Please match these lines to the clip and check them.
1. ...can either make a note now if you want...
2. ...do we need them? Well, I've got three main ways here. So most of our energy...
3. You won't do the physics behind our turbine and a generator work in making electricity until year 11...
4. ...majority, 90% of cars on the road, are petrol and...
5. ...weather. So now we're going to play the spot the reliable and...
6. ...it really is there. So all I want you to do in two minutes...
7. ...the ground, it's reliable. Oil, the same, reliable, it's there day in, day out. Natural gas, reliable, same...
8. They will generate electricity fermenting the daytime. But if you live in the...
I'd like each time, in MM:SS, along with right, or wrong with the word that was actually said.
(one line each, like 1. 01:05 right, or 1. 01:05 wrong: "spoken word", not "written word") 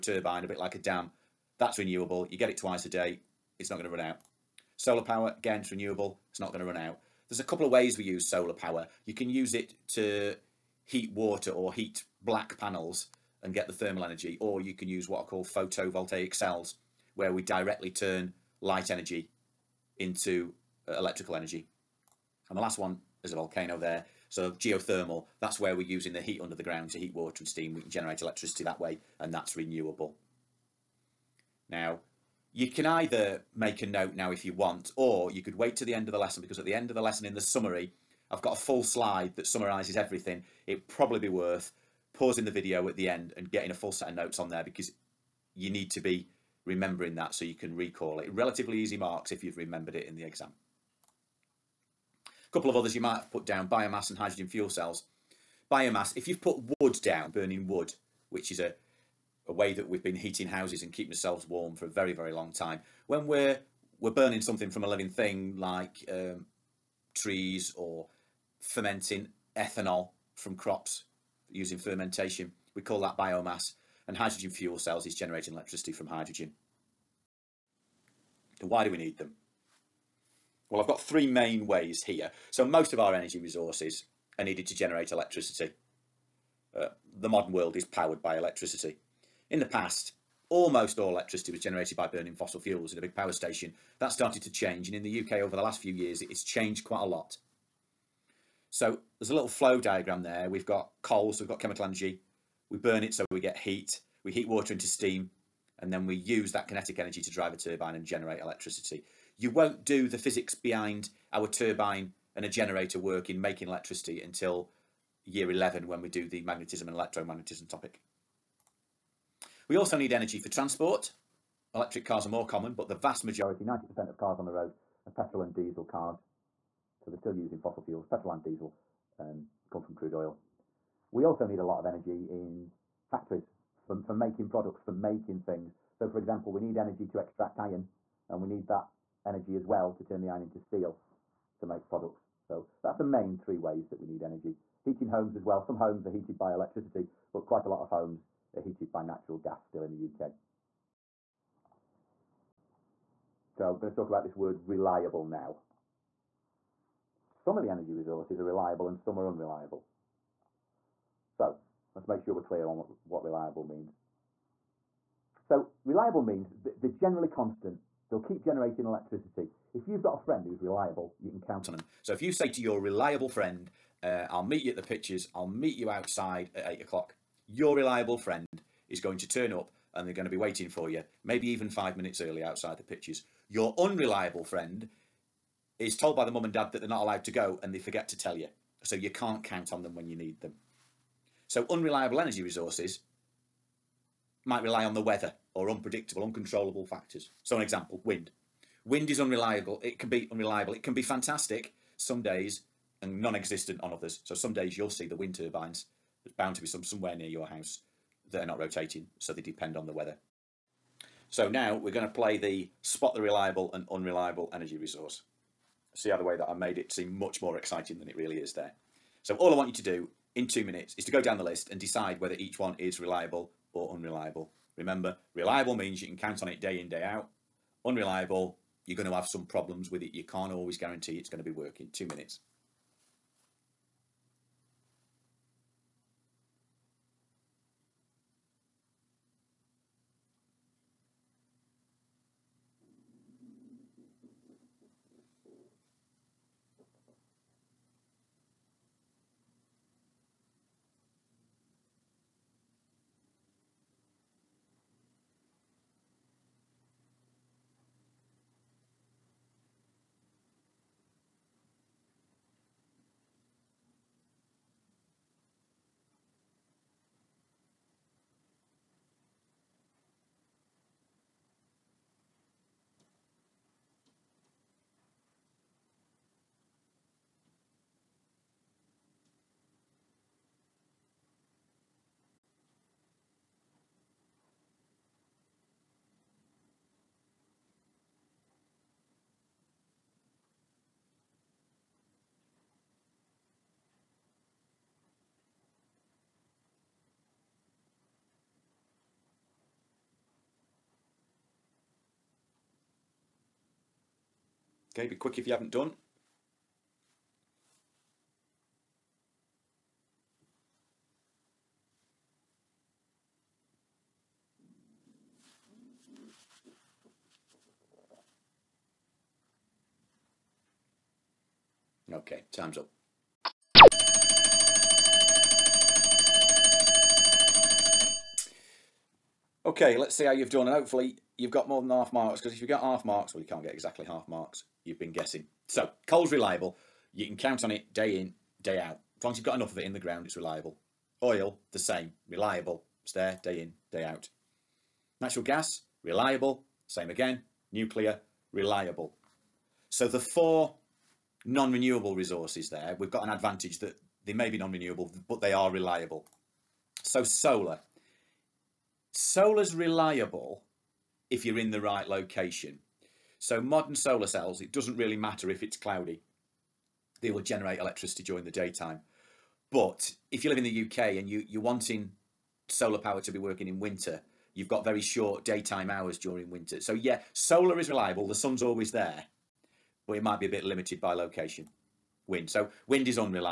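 1. 00:32 right
2. 01:18 right
3. 01:49 right
4. 02:03 right
5. 03:29 right
6. 03:38 right
7. 05:39 right
8. 06:07 wrong: "during", not "fermenting".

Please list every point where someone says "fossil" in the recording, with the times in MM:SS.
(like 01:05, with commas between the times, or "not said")
01:32, 02:07.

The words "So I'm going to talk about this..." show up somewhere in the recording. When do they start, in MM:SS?
02:33.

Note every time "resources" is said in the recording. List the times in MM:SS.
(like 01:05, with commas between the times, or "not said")
01:23, 02:37, 03:12, 03:34, 05:52.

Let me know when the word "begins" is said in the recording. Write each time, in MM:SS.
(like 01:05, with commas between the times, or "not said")
not said.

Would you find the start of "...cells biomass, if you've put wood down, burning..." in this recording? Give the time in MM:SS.
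00:54.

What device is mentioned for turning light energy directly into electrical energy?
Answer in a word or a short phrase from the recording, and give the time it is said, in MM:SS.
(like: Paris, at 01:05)
photovoltaic cells, at 00:15.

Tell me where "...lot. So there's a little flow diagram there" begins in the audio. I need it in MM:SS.
01:37.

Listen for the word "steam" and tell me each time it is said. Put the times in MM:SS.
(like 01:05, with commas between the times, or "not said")
00:27, 01:44.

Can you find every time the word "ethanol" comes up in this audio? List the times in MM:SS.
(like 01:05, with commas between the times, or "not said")
01:09.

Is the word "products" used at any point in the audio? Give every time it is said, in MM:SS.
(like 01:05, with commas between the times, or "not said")
02:14, 02:21.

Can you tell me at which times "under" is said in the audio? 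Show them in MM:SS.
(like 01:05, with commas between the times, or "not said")
00:26.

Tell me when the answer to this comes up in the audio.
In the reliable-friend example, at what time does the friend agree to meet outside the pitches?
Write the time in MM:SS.
02:56.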